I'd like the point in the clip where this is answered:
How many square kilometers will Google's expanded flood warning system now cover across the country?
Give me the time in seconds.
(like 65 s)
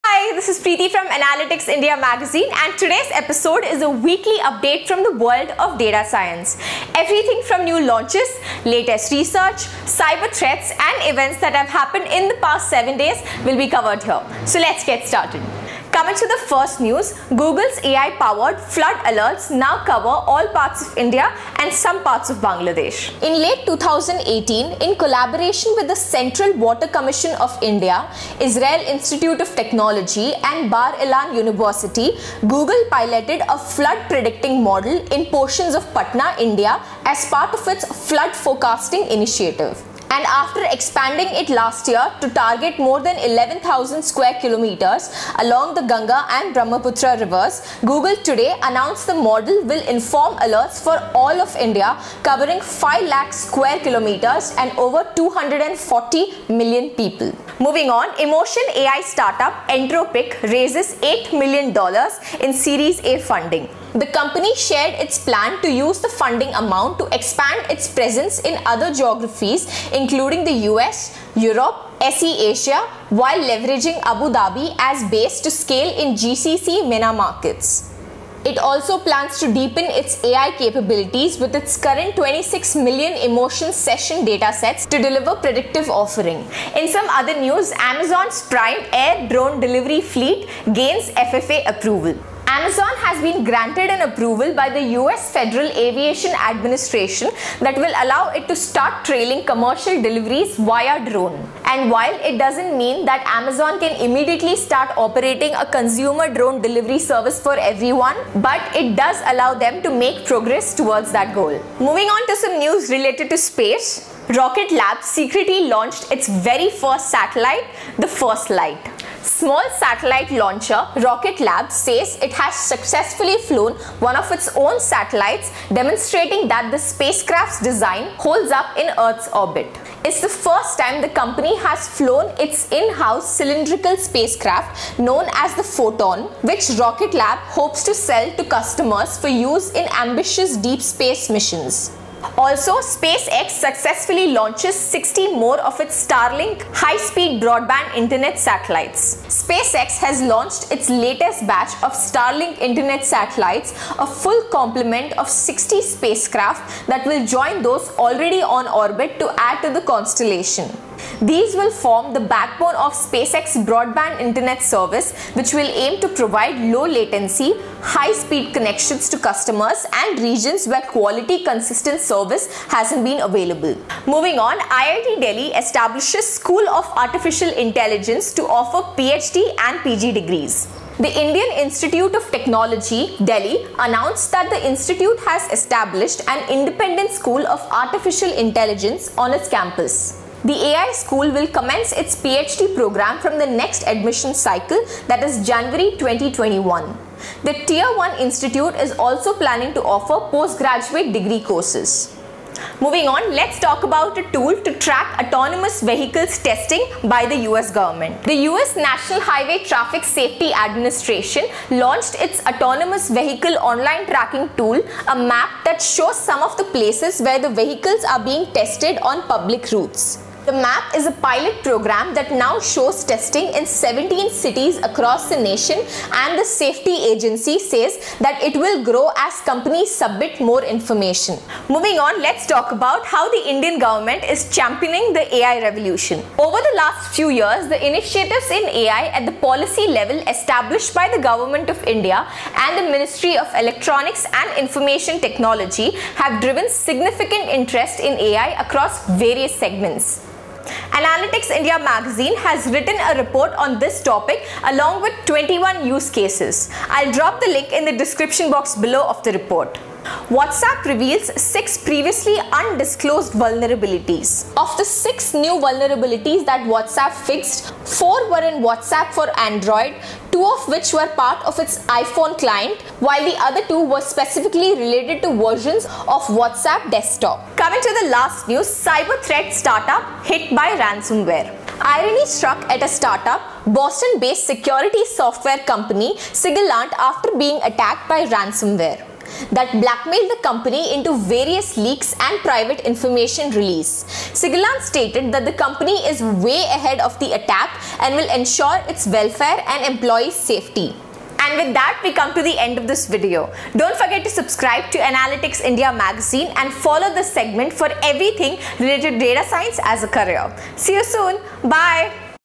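52 s.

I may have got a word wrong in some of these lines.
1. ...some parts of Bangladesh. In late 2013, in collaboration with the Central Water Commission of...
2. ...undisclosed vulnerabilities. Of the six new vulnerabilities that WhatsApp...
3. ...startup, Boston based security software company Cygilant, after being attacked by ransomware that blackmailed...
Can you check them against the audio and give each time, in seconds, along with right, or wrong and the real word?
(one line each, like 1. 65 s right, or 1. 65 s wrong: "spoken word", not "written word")
1. 21 s wrong: "2018", not "2013"
2. 262 s right
3. 282 s right.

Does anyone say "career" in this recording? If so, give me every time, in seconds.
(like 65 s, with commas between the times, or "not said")
310 s.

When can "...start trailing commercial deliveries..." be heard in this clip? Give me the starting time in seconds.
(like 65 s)
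98 s.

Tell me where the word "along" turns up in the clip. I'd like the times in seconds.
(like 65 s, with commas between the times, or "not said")
45 s, 254 s.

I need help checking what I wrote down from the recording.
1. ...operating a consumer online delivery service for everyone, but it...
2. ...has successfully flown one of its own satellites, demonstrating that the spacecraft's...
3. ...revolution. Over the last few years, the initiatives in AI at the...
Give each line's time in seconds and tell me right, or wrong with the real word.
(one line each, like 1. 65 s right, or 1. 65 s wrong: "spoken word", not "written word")
1. 104 s wrong: "drone", not "online"
2. 122 s right
3. 235 s right.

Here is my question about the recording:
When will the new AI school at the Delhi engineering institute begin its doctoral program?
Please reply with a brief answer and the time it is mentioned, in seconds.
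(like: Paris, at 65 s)
January 2021, at 195 s.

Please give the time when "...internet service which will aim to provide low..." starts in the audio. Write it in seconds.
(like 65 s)
164 s.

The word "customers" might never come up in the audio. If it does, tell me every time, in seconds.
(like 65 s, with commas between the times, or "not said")
138 s, 169 s.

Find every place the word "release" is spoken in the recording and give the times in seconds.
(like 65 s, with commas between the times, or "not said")
293 s.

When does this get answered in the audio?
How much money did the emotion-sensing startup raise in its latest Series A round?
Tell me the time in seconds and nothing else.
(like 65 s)
60 s.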